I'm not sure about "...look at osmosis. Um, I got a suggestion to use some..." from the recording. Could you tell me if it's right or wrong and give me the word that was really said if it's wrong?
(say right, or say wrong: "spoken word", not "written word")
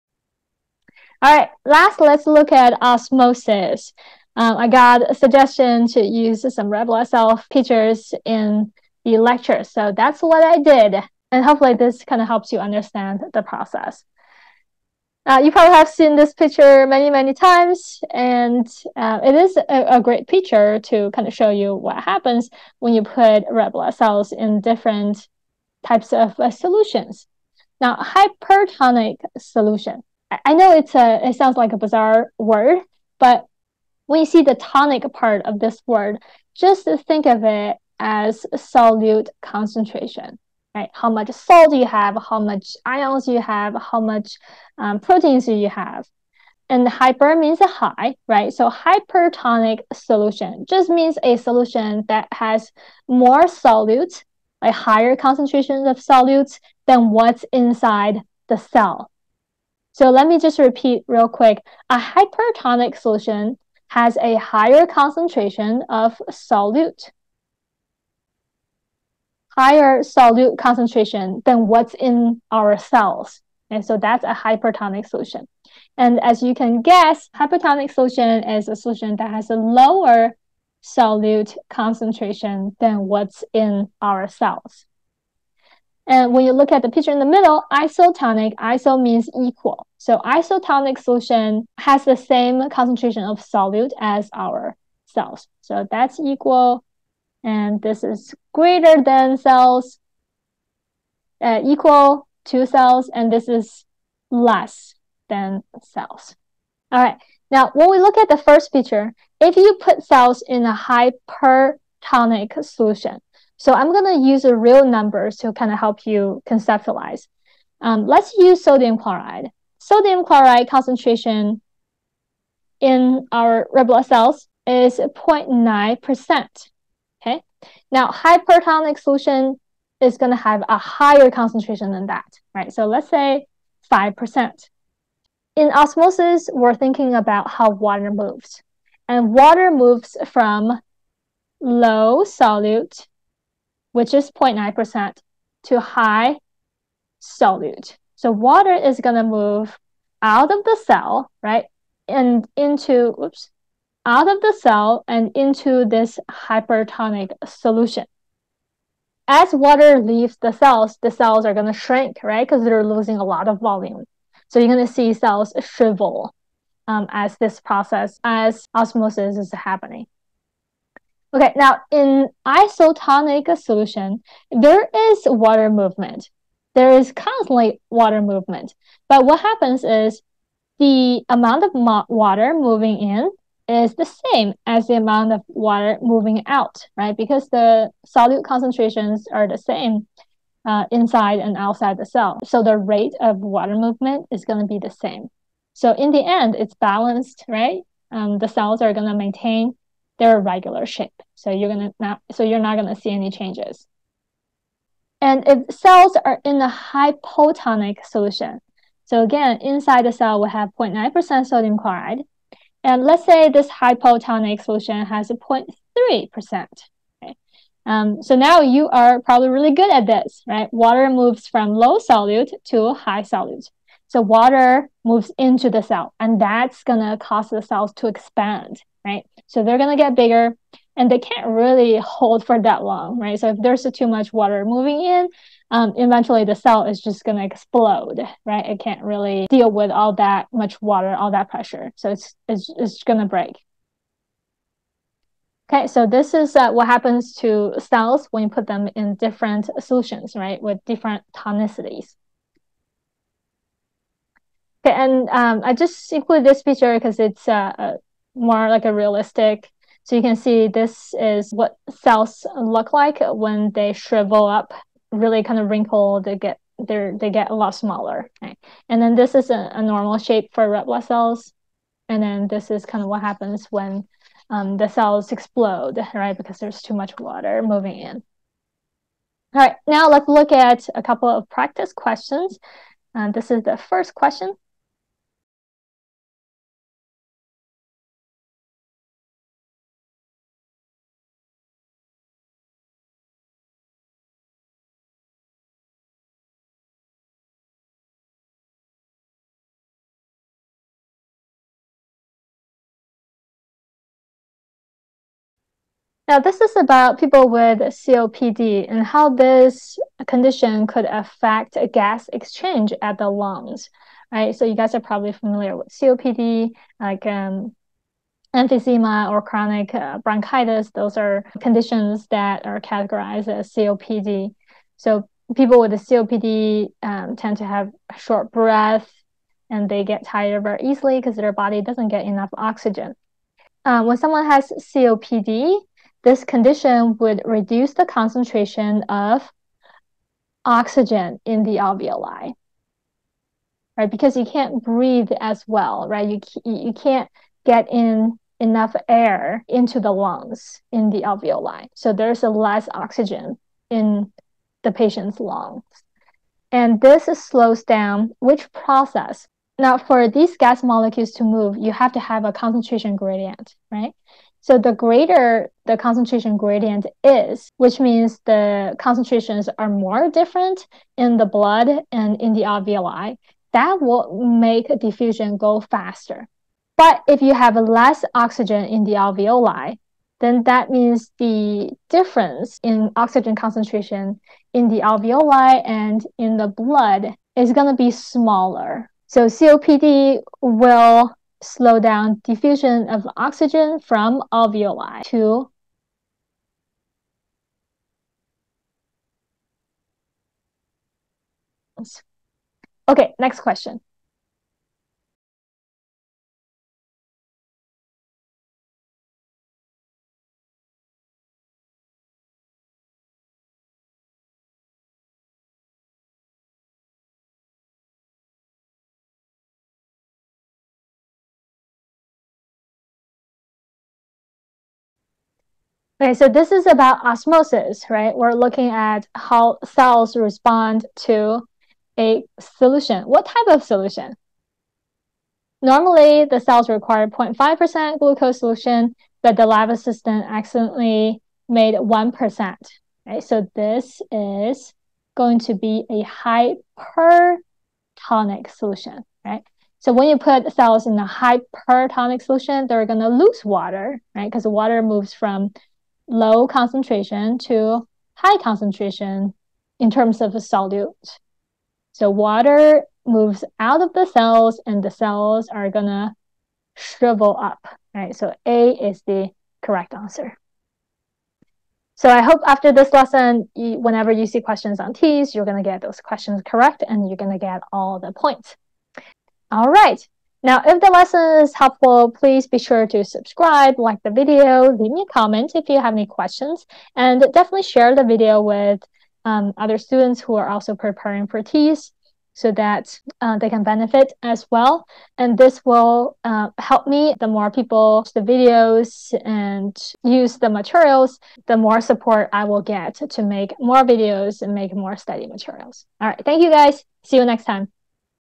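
right.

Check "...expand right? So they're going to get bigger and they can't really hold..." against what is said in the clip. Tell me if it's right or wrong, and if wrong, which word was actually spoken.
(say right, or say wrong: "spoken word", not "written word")
right.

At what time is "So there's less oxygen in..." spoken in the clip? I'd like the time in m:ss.
5:51.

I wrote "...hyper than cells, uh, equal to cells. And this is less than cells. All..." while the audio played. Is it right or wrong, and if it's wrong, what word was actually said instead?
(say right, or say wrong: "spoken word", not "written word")
wrong: "greater", not "hyper".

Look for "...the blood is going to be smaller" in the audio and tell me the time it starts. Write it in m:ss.
6:26.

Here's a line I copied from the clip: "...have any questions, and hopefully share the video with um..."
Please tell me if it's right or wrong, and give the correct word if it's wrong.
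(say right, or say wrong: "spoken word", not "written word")
wrong: "definitely", not "hopefully".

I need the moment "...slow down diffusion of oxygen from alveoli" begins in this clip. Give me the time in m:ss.
6:31.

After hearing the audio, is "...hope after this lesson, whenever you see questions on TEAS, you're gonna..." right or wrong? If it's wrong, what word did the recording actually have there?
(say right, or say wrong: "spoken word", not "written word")
right.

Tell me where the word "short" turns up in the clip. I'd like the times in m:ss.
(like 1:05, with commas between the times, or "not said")
5:28.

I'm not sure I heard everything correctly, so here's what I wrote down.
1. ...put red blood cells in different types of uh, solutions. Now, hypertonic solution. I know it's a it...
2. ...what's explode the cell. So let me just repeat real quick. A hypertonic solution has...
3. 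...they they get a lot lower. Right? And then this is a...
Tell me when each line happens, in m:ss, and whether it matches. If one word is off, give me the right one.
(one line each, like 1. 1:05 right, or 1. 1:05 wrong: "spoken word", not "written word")
1. 0:23 right
2. 0:57 wrong: "inside", not "explode"
3. 4:26 wrong: "smaller", not "lower".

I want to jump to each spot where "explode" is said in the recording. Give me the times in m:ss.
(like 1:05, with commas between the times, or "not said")
3:57, 4:35.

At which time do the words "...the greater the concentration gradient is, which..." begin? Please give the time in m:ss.
6:04.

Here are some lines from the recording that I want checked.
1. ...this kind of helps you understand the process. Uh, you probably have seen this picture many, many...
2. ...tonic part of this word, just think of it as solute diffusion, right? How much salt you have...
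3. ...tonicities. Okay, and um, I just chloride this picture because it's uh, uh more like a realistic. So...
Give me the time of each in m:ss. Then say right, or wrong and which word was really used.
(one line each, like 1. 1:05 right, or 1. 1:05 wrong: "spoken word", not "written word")
1. 0:11 right
2. 0:34 wrong: "concentration", not "diffusion"
3. 4:11 wrong: "include", not "chloride".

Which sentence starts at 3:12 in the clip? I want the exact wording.
So the rate of water movement is going to be the same.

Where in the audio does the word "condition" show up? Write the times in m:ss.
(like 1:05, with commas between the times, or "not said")
5:10, 5:21, 5:36.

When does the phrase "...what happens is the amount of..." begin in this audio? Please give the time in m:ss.
2:59.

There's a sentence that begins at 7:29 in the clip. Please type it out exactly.
So when you put cells in a hypertonic solution, they're going to lose water, right?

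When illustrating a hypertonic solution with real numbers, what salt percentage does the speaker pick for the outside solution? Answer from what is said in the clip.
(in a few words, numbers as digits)
5%.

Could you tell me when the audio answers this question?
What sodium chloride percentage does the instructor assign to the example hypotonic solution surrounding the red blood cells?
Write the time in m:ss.
3:35.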